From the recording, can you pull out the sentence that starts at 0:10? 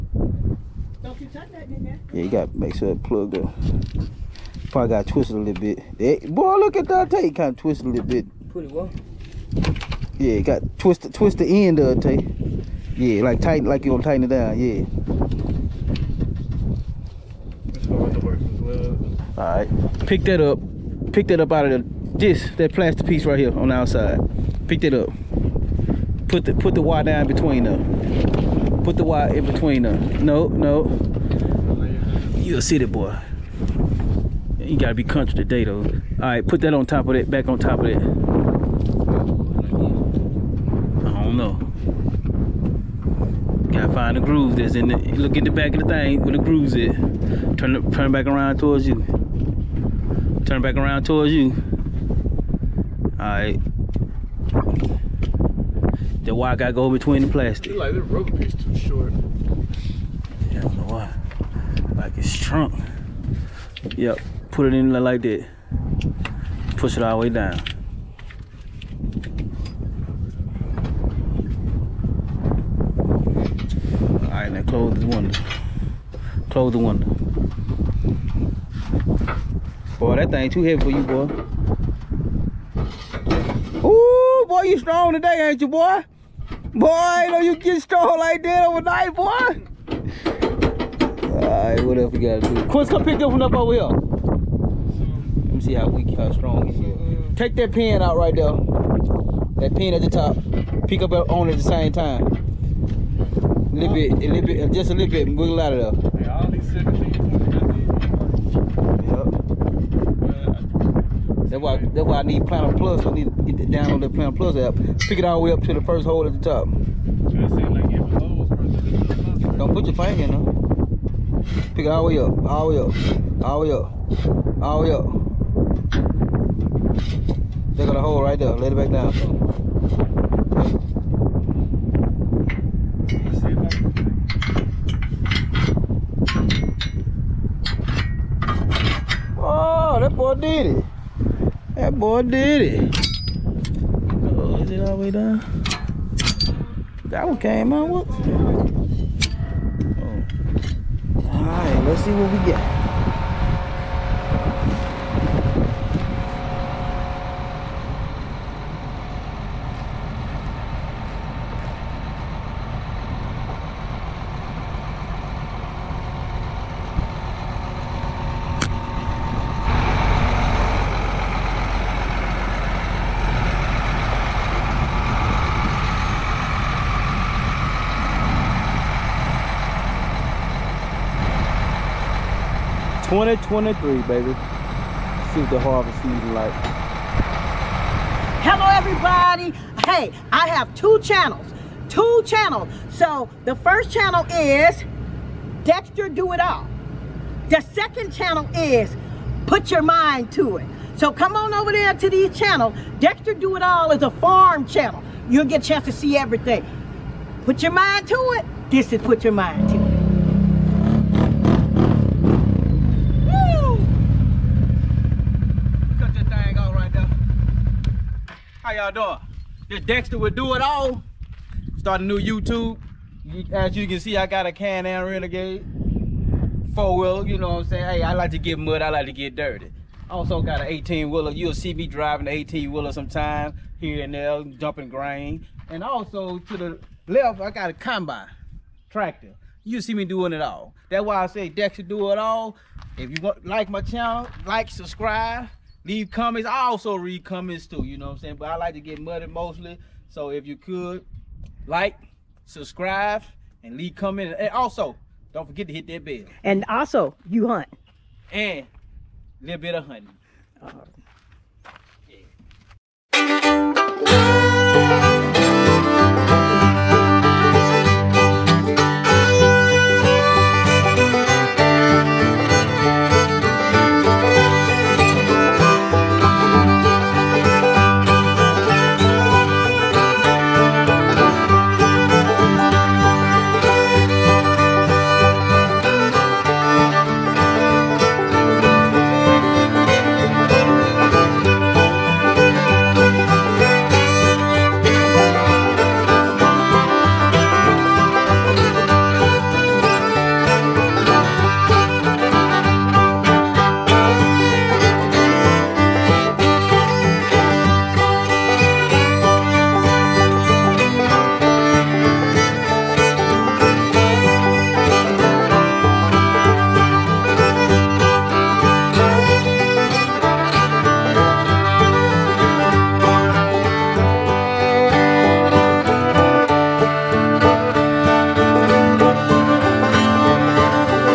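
Yeah, got twisted, twist the end of the tape.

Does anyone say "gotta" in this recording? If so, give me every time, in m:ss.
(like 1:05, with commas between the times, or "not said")
0:02, 0:34, 0:43, 0:56, 1:32.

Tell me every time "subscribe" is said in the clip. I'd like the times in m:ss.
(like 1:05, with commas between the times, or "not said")
4:04, 4:12.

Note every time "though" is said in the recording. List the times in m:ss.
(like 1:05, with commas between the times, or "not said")
0:35.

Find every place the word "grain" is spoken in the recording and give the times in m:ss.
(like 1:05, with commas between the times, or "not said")
3:54.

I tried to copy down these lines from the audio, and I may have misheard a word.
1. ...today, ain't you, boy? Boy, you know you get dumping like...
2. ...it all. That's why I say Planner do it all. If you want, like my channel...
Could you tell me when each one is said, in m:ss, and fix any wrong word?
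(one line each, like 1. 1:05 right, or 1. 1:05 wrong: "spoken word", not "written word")
1. 1:25 wrong: "strong", not "dumping"
2. 4:00 wrong: "Dexter", not "Planner".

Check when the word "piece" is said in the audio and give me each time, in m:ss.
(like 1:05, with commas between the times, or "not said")
0:23, 0:58.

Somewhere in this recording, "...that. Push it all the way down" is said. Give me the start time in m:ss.
1:05.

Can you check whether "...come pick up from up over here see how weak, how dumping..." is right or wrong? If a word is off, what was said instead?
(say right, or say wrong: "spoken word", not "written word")
wrong: "strong", not "dumping".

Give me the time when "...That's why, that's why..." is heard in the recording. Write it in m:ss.
1:51.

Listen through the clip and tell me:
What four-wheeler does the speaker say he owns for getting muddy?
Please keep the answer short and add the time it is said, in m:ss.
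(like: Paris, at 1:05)
Can-Am Renegade, at 3:44.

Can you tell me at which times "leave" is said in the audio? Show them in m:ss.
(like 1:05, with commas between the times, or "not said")
4:05, 4:13.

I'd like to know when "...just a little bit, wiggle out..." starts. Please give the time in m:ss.
1:44.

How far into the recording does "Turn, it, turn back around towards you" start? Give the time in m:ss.
0:47.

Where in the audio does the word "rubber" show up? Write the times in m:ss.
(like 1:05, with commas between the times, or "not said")
0:58.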